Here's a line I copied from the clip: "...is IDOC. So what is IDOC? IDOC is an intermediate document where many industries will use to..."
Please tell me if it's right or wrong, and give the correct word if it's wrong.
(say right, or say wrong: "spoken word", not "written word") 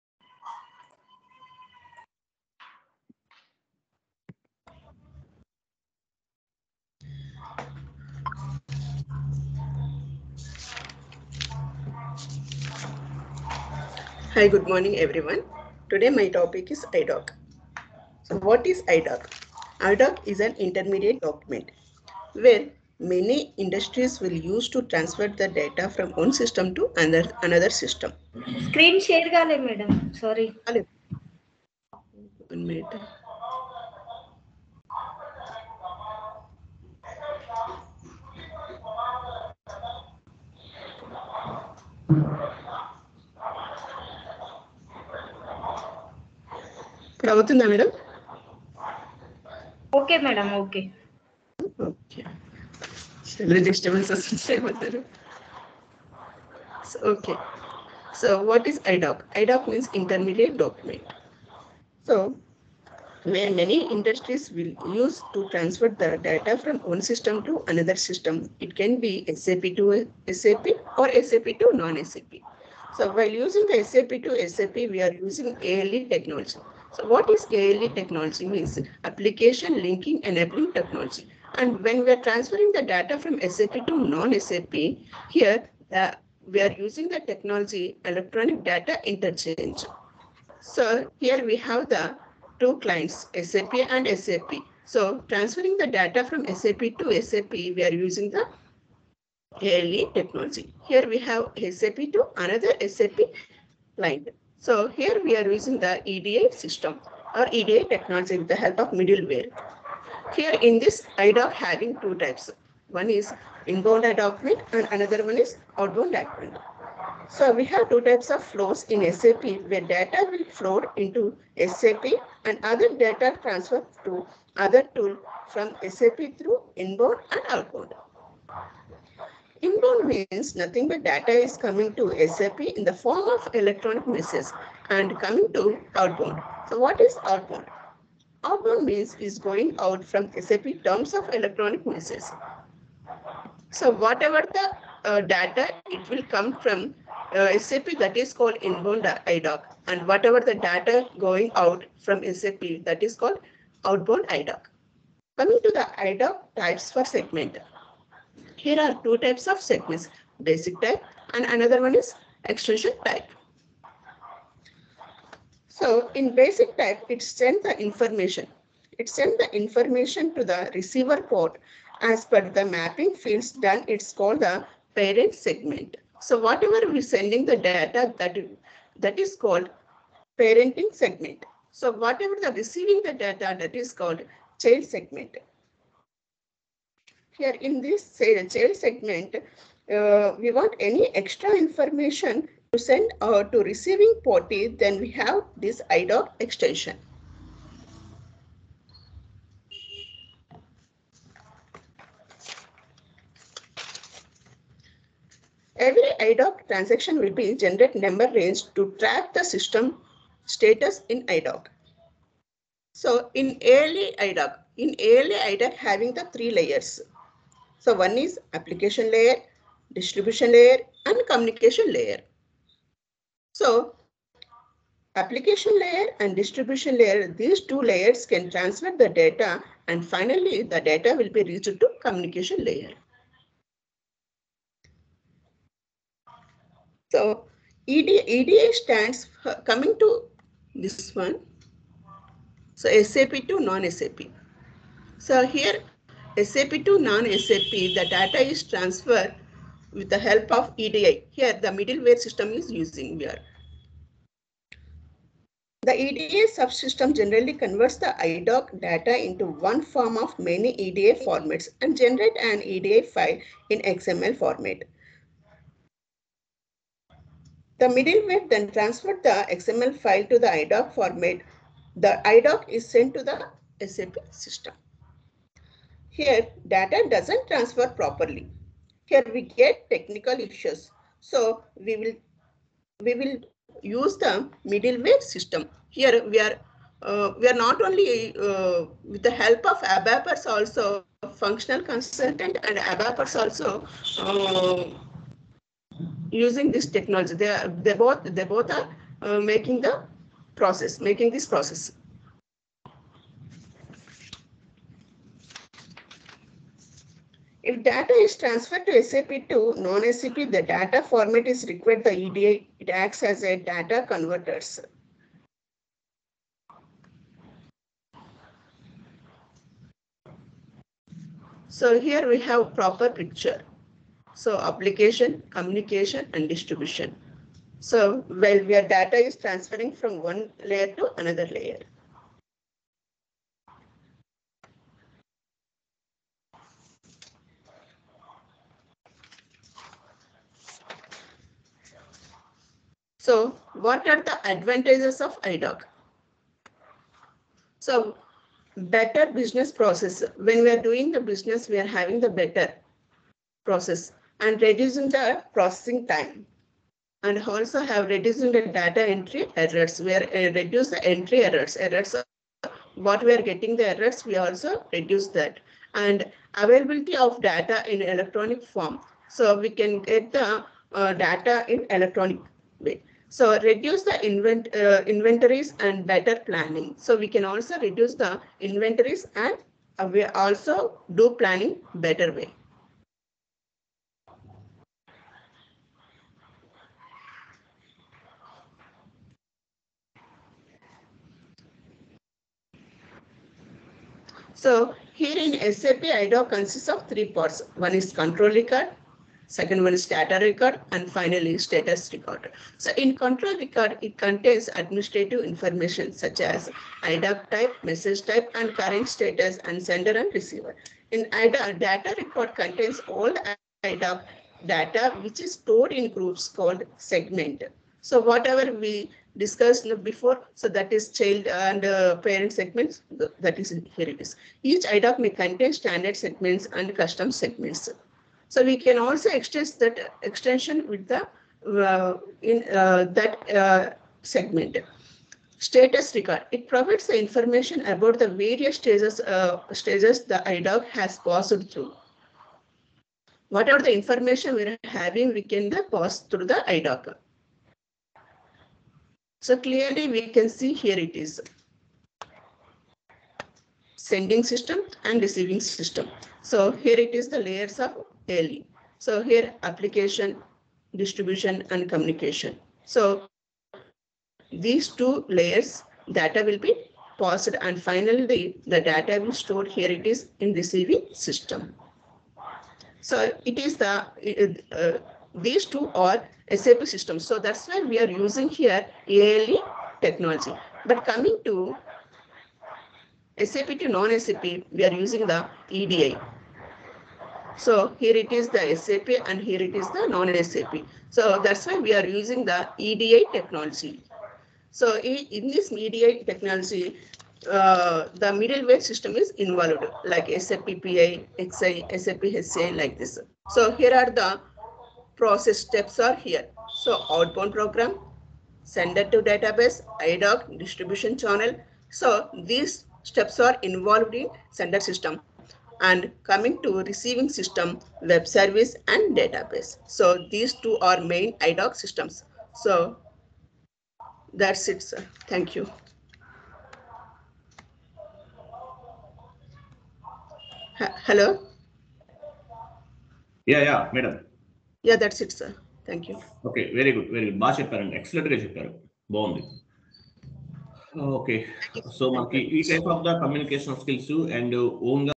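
right.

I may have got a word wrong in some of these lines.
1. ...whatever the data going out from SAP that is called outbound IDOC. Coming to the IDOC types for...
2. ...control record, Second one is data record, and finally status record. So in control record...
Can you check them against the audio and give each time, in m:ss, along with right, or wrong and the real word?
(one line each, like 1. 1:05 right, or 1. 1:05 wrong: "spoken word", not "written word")
1. 2:30 right
2. 6:38 right.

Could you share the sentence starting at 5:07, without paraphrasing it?
If data is transferred to SAP to non-SAP, the data format is required the EDA.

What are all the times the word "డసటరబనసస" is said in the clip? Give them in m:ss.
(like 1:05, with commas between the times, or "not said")
0:53.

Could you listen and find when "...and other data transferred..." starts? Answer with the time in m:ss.
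2:02.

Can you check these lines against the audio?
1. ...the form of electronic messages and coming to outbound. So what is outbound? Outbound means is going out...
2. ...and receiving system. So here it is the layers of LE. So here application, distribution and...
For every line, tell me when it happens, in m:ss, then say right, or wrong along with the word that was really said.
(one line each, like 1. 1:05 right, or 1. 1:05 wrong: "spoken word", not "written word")
1. 2:12 right
2. 7:35 right.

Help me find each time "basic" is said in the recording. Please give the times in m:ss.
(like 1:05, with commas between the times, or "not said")
2:40, 2:46.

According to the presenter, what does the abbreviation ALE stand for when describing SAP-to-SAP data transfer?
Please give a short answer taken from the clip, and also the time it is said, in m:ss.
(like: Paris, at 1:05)
Application linking enabling, at 1:19.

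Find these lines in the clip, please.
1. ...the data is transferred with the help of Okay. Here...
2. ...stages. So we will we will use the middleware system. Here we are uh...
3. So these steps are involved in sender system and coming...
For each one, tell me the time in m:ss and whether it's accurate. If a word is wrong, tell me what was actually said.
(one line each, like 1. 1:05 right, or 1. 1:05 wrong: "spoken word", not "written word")
1. 4:07 wrong: "EDI", not "Okay"
2. 4:40 wrong: "issues", not "stages"
3. 8:31 right.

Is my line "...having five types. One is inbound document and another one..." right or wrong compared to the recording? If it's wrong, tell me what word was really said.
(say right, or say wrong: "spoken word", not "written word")
wrong: "two", not "five".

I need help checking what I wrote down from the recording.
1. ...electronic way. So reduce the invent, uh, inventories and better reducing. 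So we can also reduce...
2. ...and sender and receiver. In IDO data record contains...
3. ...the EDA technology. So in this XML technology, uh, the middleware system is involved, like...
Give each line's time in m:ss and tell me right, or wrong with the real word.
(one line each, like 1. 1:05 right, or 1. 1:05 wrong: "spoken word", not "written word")
1. 6:11 wrong: "planning", not "reducing"
2. 6:49 wrong: "IDA", not "IDO"
3. 8:12 wrong: "EDA", not "XML".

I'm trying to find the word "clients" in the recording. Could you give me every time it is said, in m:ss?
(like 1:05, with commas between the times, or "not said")
1:32, 1:43.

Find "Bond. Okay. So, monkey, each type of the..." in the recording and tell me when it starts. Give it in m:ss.
8:59.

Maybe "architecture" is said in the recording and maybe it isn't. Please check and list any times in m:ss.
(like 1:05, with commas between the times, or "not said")
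not said.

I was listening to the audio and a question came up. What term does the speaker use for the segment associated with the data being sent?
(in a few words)
Parent segment.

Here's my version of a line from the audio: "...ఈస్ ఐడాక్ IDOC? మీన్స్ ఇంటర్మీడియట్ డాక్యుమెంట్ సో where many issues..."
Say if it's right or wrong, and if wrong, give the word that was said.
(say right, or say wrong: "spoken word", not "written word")
wrong: "industries", not "issues".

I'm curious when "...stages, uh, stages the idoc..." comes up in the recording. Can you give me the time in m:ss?
7:18.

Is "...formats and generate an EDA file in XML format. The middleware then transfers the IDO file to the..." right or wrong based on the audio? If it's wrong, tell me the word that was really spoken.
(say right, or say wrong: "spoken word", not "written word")
wrong: "XML", not "IDO".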